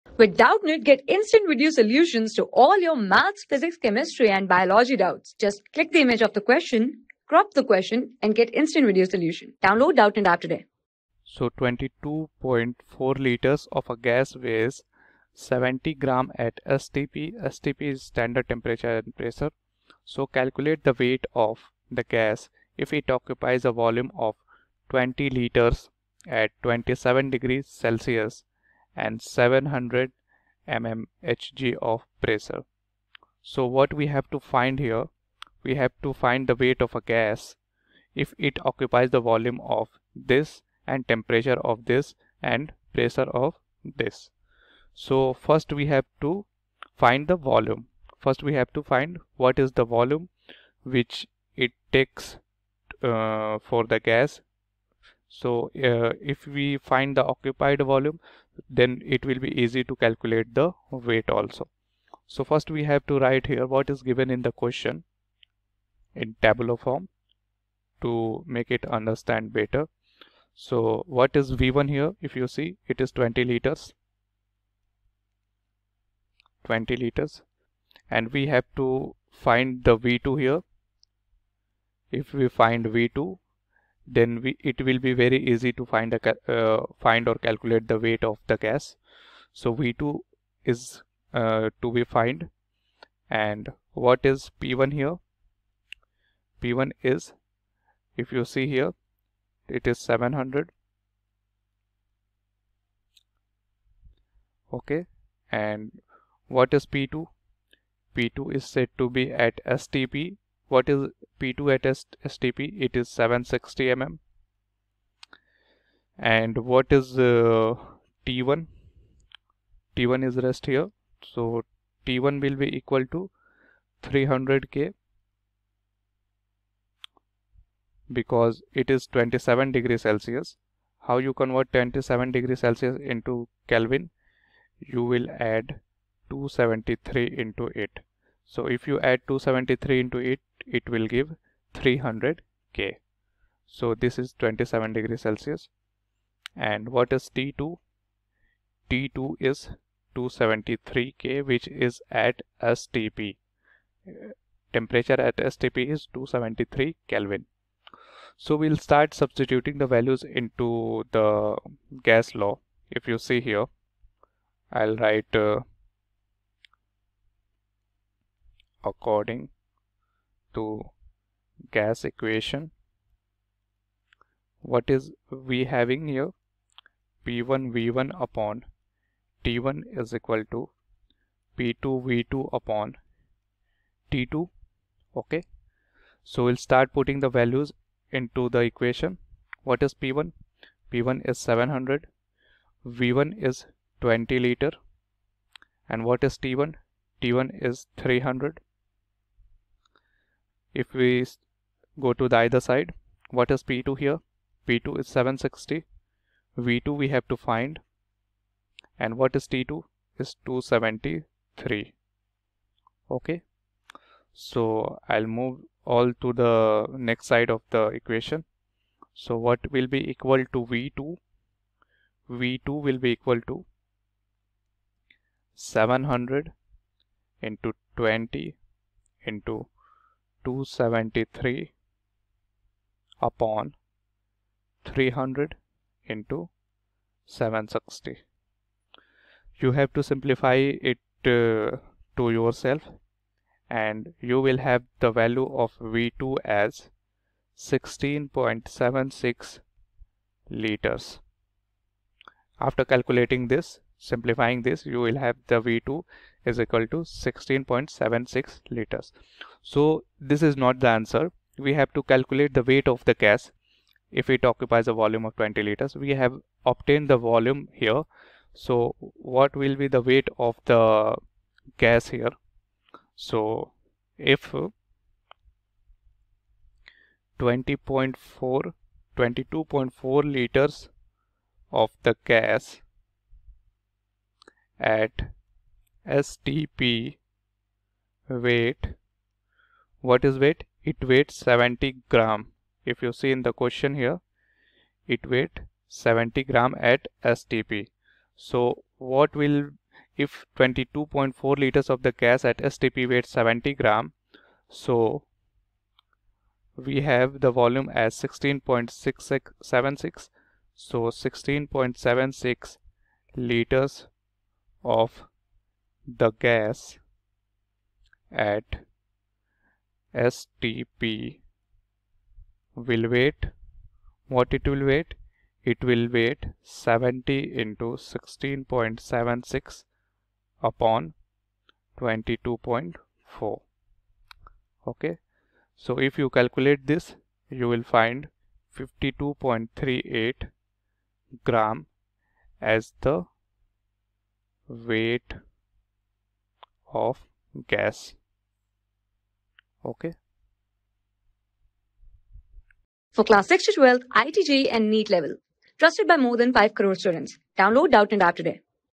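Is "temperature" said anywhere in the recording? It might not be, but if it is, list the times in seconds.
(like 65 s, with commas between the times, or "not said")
18 s, 41 s, 154 s.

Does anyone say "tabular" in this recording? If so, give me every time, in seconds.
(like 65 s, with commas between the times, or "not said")
66 s.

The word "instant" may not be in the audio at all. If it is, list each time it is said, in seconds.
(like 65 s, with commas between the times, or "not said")
1 s, 8 s.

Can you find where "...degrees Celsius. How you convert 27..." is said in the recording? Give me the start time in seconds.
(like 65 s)
129 s.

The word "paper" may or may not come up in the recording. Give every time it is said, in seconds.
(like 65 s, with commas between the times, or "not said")
not said.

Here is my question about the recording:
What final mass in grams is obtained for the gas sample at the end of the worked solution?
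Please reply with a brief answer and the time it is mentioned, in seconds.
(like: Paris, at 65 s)
52.38 grams, at 338 s.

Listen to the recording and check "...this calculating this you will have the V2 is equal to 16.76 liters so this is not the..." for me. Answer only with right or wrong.
wrong.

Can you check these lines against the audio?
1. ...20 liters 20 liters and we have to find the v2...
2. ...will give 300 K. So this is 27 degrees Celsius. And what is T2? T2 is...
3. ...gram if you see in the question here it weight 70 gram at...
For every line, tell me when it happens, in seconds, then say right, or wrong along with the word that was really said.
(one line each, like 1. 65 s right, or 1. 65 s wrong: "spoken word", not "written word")
1. 73 s right
2. 140 s right
3. 292 s right.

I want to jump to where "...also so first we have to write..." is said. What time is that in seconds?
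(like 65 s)
61 s.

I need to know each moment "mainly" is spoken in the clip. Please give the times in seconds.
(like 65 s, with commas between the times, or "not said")
not said.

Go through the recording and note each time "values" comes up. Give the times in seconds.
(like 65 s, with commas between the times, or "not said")
159 s, 187 s, 245 s.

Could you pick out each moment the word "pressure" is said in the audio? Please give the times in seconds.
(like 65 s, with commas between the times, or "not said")
19 s, 32 s, 42 s.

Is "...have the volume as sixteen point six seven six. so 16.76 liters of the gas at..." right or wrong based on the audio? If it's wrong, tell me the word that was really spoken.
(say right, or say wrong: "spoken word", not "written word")
right.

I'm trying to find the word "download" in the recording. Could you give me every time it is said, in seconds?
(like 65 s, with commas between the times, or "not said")
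9 s, 357 s.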